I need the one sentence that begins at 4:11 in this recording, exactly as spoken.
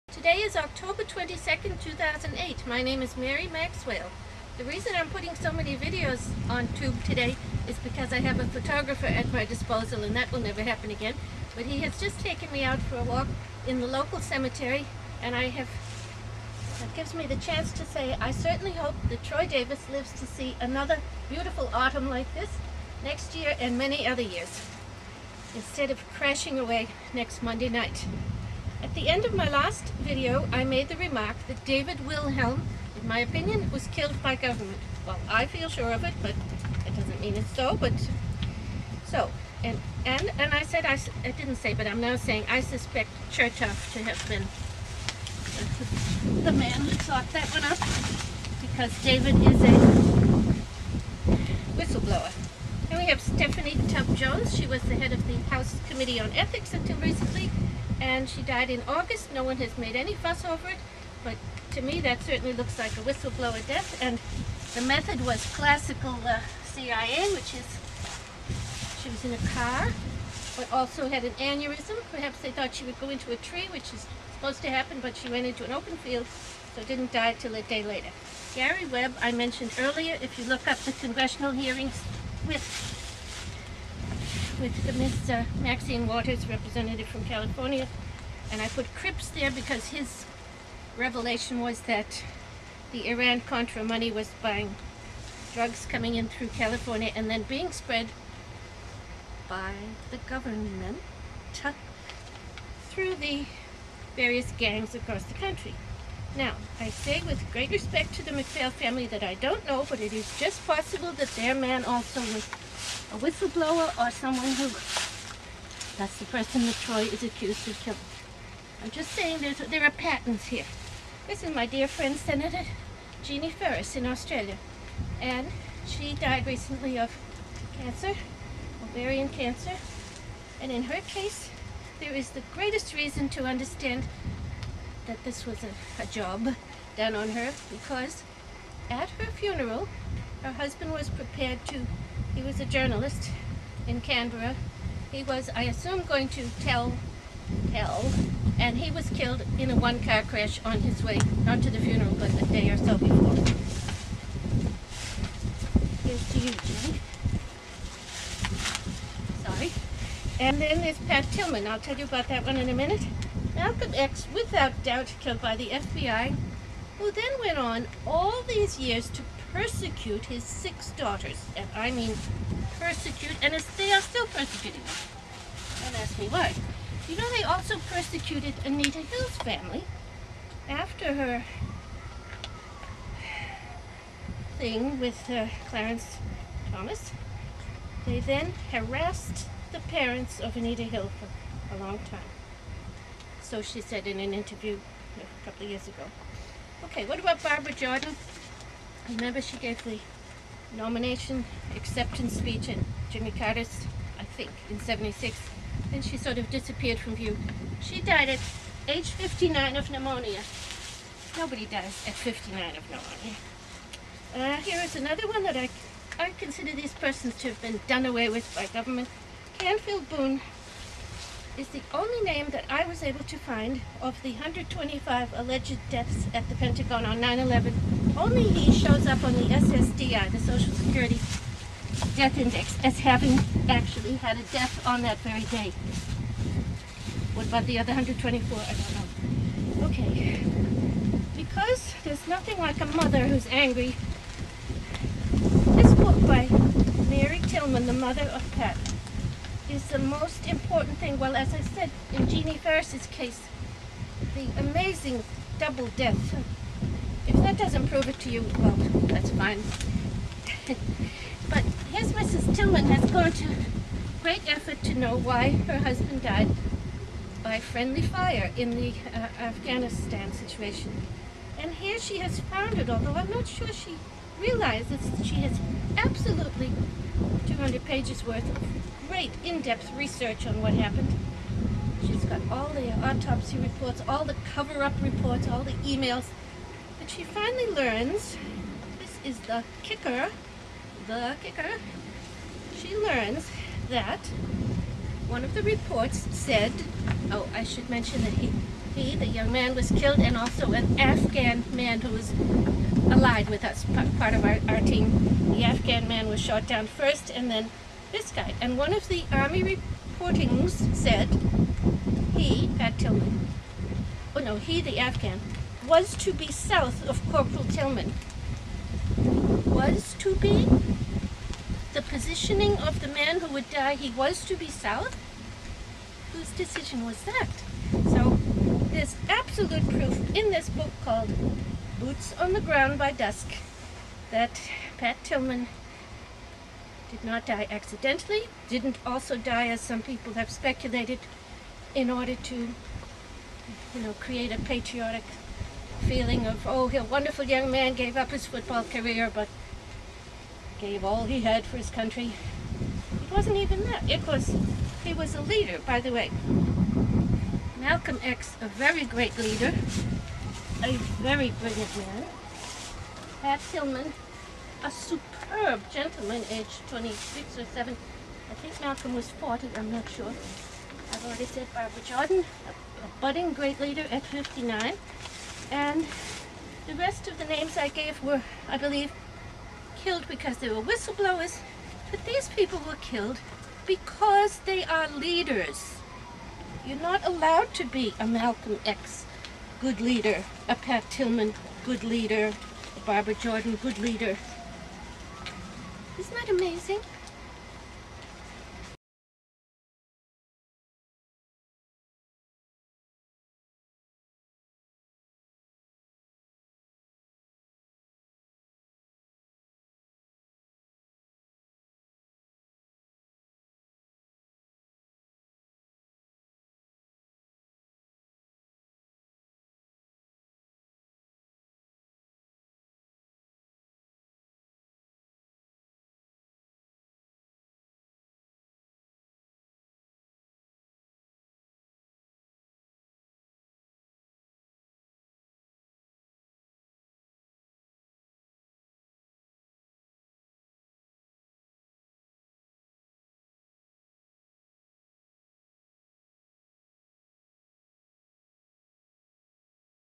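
Well, as I said, in Jeannie Ferris's case, the amazing double death.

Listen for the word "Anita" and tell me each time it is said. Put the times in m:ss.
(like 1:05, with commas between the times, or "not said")
2:58, 3:10.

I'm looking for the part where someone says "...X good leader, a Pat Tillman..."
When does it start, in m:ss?
6:28.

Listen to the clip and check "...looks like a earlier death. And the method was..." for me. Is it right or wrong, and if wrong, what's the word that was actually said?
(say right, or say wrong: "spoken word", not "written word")
wrong: "whistleblower", not "earlier".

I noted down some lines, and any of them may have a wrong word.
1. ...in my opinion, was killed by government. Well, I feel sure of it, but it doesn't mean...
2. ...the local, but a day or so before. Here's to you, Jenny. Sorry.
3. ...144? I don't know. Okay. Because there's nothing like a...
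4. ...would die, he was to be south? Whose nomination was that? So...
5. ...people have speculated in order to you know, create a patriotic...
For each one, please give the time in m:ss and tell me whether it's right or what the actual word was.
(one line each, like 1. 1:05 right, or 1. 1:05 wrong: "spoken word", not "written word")
1. 0:32 right
2. 2:31 wrong: "funeral", not "local"
3. 3:57 wrong: "124", not "144"
4. 5:23 wrong: "decision", not "nomination"
5. 5:40 right.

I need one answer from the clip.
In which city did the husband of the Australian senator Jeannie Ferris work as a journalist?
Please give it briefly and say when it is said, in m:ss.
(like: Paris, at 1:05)
Canberra, at 2:24.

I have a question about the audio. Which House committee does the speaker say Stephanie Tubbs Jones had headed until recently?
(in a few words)
House Committee on Ethics.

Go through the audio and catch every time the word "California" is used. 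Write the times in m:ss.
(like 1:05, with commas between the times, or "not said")
1:27, 1:36.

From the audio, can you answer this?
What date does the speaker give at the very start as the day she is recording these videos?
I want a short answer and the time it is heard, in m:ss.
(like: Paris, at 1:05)
October 22nd, 2008, at 0:00.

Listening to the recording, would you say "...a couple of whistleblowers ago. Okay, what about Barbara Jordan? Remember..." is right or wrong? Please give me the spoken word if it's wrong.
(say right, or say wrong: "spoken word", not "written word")
wrong: "years", not "whistleblowers".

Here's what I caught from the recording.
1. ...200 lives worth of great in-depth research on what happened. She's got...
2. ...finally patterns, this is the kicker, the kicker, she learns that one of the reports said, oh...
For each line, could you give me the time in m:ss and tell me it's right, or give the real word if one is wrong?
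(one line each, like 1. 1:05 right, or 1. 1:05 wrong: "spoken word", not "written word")
1. 4:37 wrong: "pages", not "lives"
2. 4:47 wrong: "learns", not "patterns".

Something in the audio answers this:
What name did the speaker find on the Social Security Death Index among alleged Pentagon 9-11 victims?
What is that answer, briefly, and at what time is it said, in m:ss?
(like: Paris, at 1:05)
Canfield Boone, at 3:39.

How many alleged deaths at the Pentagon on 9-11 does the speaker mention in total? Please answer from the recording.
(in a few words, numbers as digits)
125.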